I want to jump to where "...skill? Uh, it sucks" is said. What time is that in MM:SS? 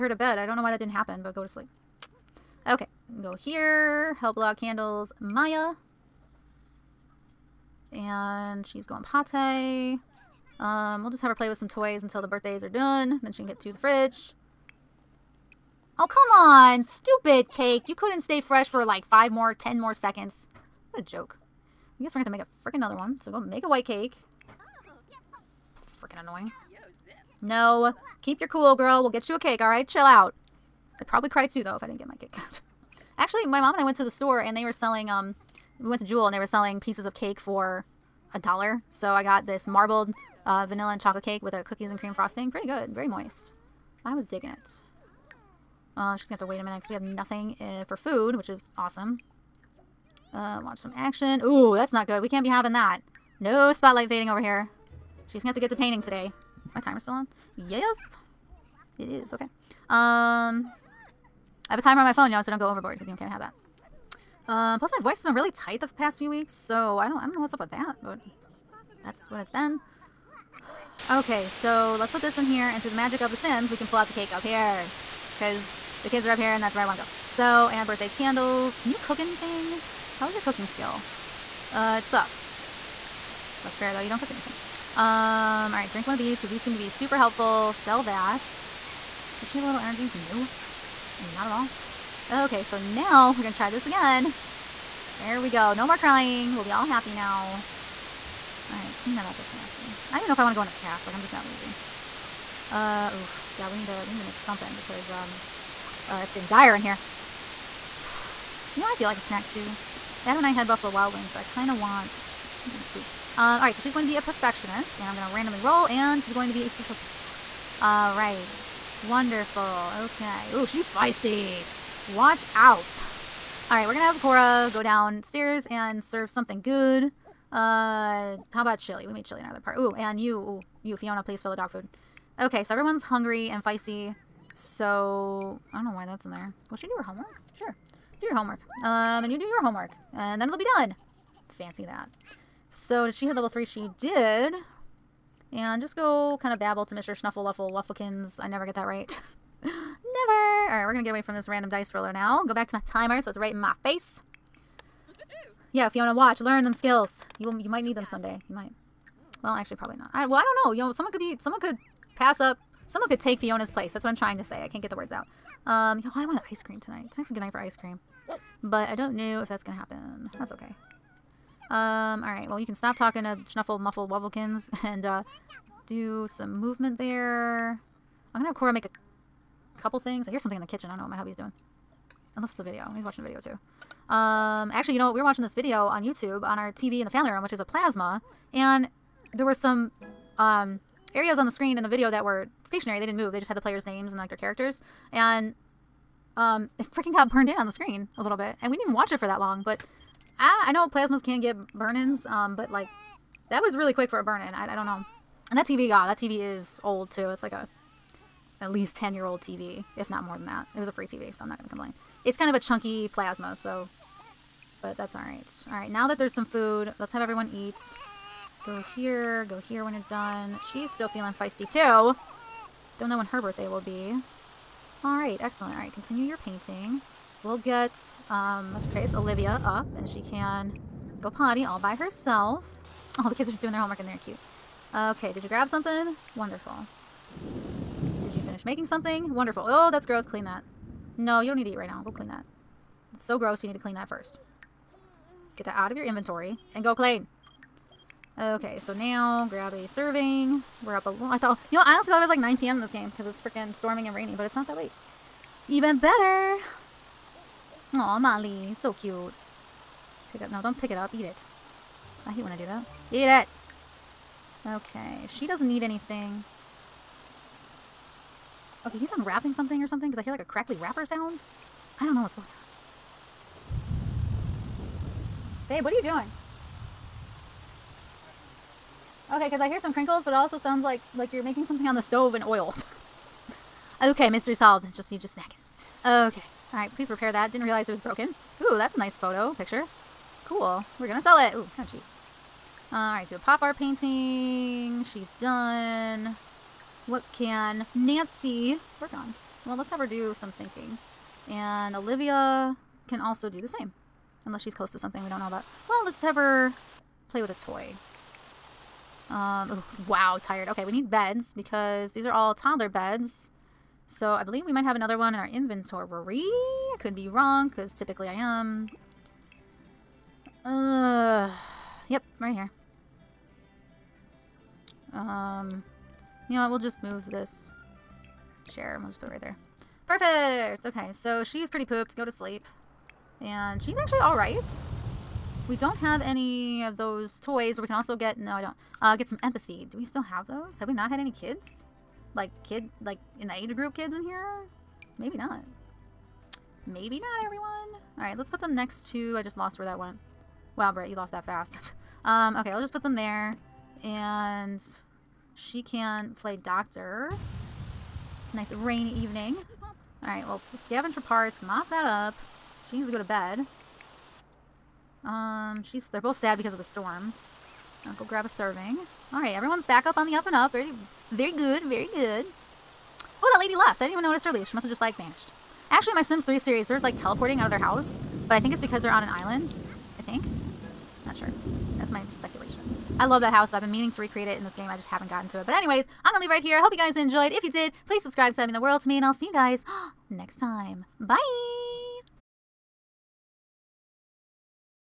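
01:20.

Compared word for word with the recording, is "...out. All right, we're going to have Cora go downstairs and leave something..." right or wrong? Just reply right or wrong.
wrong.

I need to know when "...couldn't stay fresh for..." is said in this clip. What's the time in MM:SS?
00:17.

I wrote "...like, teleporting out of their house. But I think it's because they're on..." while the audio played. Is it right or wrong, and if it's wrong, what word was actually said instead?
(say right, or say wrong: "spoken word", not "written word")
right.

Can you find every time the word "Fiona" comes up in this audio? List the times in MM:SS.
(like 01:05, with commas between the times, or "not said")
02:10, 02:35, 02:43.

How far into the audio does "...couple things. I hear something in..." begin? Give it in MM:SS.
02:59.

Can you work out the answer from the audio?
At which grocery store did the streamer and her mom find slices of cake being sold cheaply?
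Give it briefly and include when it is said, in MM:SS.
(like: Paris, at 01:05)
Jewel, at 00:36.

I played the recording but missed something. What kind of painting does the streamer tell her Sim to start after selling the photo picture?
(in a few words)
Pop art.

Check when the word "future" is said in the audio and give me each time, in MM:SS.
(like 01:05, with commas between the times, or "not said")
not said.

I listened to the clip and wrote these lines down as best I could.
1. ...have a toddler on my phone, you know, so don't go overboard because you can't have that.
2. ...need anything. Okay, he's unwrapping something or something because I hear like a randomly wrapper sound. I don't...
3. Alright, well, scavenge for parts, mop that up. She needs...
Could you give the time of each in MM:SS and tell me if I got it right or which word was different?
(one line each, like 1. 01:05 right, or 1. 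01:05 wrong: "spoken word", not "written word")
1. 01:01 wrong: "timer", not "toddler"
2. 04:25 wrong: "crackly", not "randomly"
3. 06:00 right.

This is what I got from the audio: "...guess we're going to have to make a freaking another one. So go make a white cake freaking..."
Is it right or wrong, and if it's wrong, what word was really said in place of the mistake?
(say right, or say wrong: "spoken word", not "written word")
right.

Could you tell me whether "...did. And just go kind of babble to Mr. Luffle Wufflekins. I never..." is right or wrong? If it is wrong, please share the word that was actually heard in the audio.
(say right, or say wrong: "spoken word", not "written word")
right.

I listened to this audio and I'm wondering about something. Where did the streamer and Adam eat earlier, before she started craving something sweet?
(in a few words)
Buffalo Wild Wings.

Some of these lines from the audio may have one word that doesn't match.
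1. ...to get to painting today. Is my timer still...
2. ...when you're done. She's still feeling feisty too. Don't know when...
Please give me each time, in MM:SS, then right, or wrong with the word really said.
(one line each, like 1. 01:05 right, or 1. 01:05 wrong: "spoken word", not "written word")
1. 00:55 right
2. 03:39 right.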